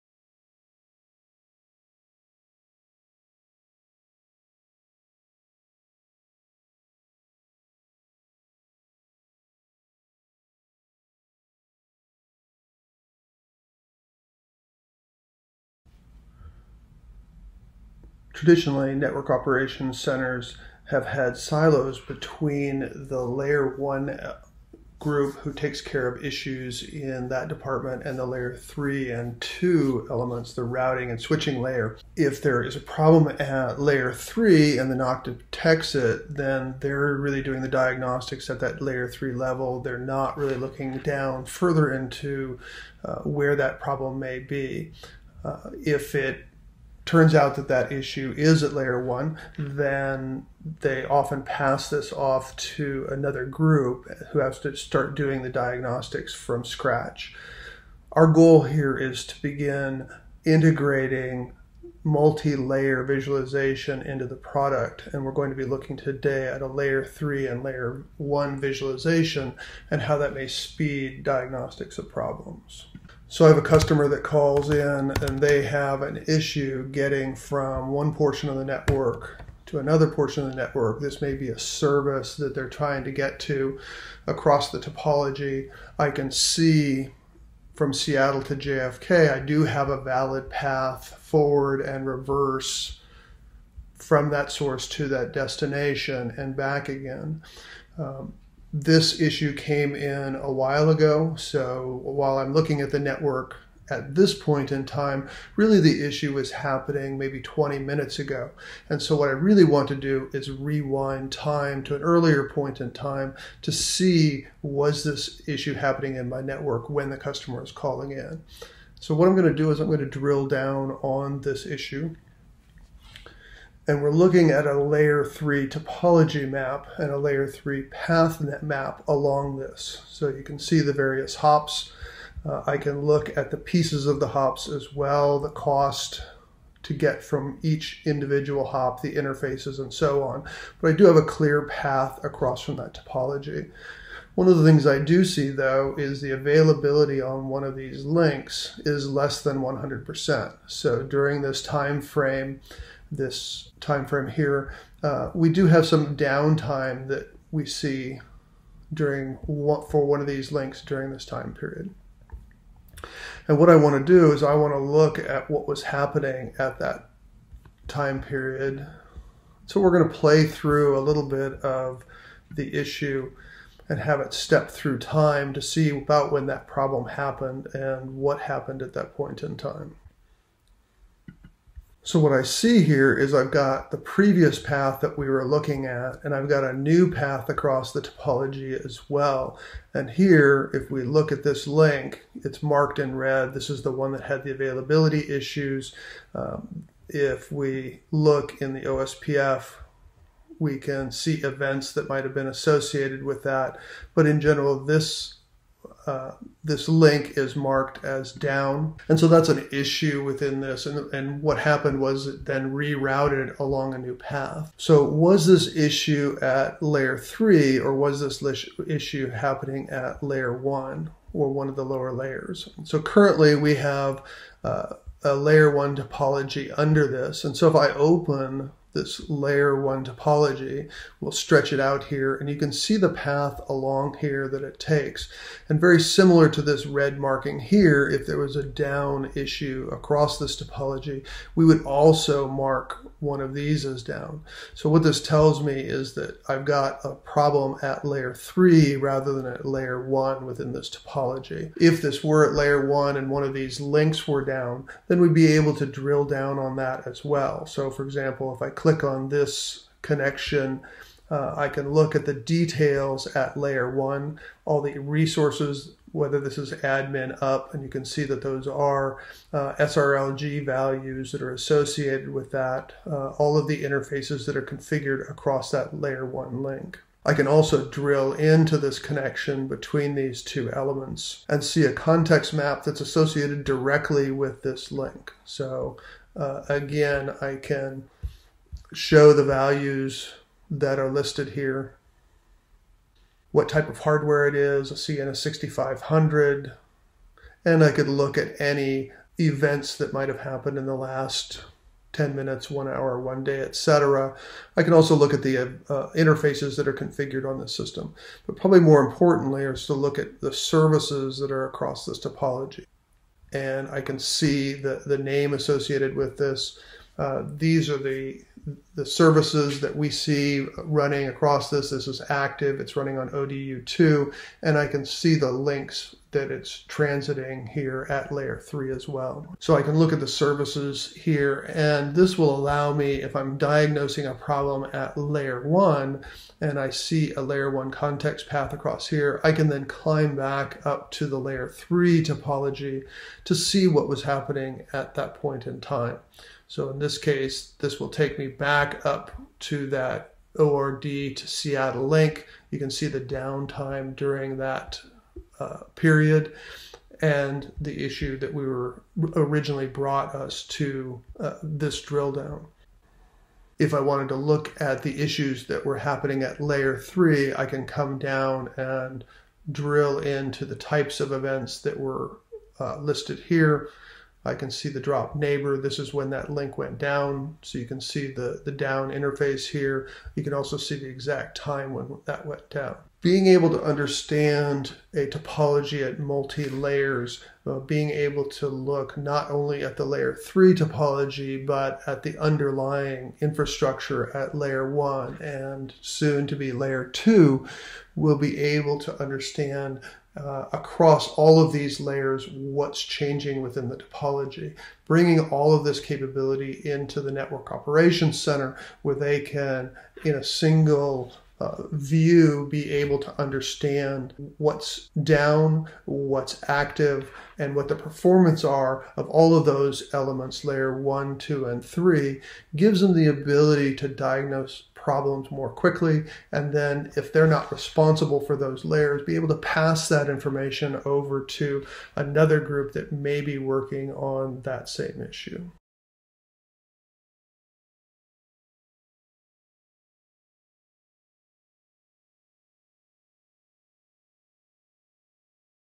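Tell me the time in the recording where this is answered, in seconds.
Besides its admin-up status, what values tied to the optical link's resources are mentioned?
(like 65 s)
269 s.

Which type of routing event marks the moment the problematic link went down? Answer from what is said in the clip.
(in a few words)
Drop neighbor.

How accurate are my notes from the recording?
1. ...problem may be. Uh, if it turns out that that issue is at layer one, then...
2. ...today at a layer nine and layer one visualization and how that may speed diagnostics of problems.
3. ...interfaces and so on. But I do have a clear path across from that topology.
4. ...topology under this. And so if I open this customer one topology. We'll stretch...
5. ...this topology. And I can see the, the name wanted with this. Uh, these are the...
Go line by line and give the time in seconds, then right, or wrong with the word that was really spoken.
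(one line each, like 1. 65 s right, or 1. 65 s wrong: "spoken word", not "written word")
1. 43 s right
2. 65 s wrong: "three", not "nine"
3. 139 s right
4. 225 s wrong: "layer", not "customer"
5. 312 s wrong: "associated", not "wanted".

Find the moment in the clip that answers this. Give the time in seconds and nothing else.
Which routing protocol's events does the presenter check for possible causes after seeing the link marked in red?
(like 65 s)
198 s.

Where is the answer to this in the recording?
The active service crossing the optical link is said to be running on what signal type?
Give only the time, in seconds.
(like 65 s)
323 s.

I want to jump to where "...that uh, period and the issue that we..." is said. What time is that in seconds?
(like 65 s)
354 s.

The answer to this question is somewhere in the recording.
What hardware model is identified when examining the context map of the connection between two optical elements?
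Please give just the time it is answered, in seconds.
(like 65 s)
295 s.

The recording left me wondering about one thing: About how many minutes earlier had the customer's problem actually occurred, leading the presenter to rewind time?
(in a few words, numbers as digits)
20.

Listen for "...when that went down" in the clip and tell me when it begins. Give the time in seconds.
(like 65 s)
381 s.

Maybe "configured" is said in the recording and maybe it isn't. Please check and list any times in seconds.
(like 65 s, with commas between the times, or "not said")
274 s, 306 s.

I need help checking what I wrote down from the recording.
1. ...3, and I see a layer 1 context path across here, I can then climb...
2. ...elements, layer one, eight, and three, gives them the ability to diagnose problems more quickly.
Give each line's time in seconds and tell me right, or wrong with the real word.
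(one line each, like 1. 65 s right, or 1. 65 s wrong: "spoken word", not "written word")
1. 335 s wrong: "1", not "3"
2. 420 s wrong: "two", not "eight".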